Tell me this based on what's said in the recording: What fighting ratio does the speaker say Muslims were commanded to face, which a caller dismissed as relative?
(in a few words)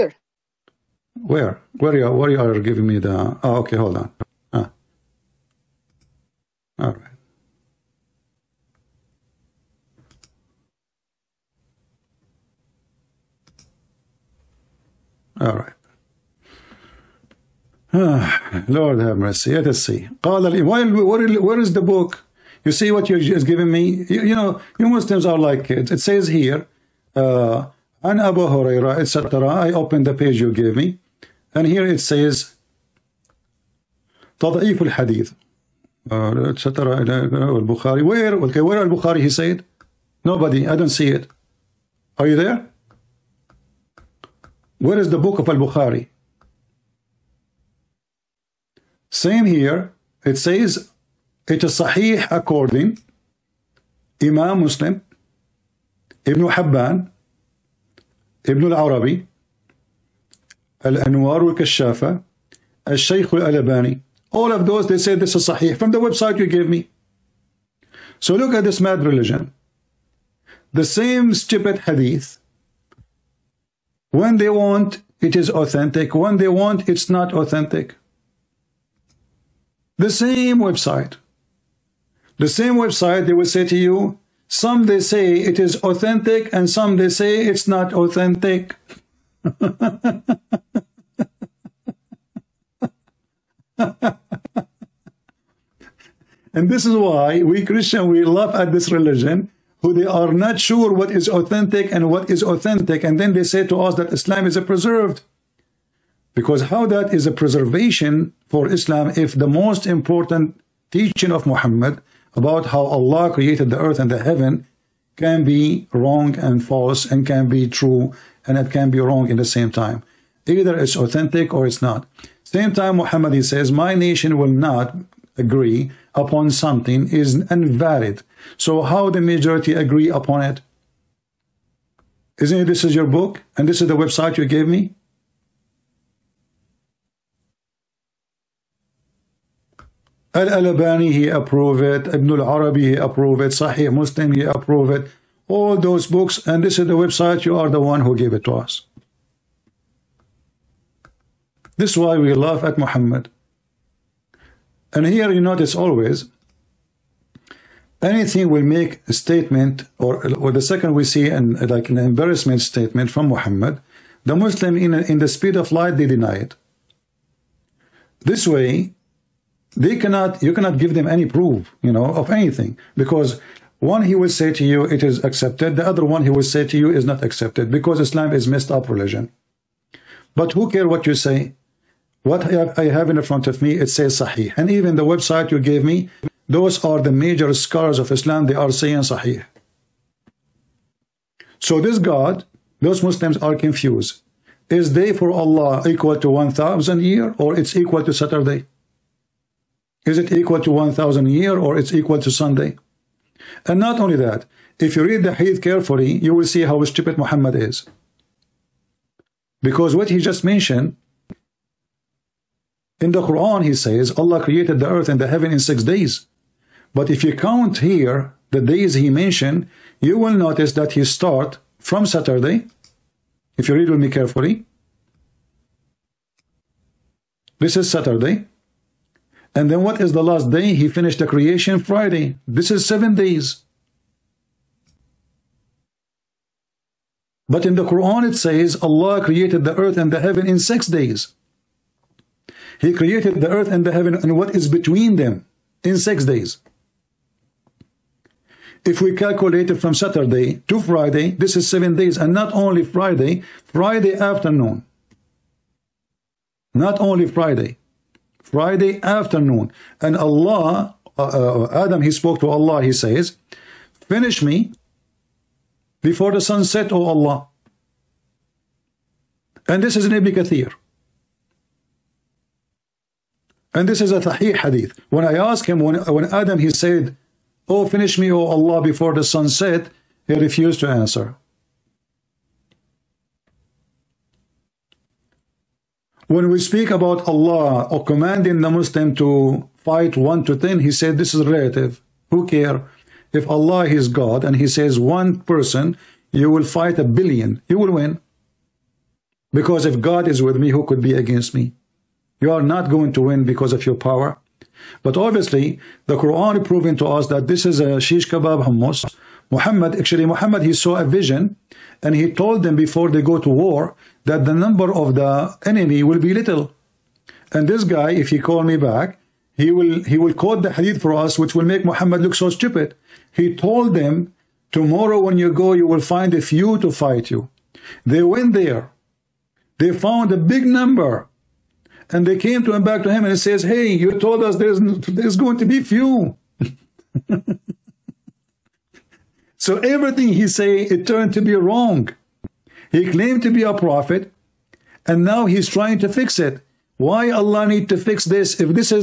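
1 to 10.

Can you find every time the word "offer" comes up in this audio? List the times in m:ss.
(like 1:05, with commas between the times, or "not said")
not said.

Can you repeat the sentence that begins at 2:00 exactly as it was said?
Either it's authentic or it's not.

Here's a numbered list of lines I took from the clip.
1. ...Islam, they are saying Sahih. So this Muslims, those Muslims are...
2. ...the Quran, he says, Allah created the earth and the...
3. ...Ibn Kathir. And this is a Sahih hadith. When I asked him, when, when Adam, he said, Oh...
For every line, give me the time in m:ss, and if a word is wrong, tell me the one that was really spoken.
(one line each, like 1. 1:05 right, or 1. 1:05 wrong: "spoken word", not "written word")
1. 3:08 wrong: "God", not "Muslims"
2. 3:33 right
3. 4:30 right.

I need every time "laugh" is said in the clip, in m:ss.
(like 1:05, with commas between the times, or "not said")
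1:38, 2:32.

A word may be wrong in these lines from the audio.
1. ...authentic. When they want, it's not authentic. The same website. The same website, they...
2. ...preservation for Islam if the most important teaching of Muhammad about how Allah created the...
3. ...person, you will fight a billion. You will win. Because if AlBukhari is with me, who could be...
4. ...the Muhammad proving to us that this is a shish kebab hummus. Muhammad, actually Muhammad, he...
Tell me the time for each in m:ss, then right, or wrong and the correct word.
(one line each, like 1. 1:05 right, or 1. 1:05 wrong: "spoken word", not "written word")
1. 1:15 right
2. 1:47 right
3. 4:55 wrong: "God", not "AlBukhari"
4. 5:06 wrong: "Quran", not "Muhammad".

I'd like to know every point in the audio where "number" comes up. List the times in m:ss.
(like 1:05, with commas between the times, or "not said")
5:14, 5:30.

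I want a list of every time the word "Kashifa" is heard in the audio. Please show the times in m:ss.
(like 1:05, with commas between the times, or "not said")
1:01.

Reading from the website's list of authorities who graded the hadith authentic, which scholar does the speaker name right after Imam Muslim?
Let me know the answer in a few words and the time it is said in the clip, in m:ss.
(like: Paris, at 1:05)
Ibn Hibban, at 0:56.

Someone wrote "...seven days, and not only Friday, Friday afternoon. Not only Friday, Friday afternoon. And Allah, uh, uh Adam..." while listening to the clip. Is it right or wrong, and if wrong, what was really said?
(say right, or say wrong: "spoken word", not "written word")
right.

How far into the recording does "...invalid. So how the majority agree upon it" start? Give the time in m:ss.
2:07.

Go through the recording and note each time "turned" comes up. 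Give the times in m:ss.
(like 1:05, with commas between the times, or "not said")
5:41.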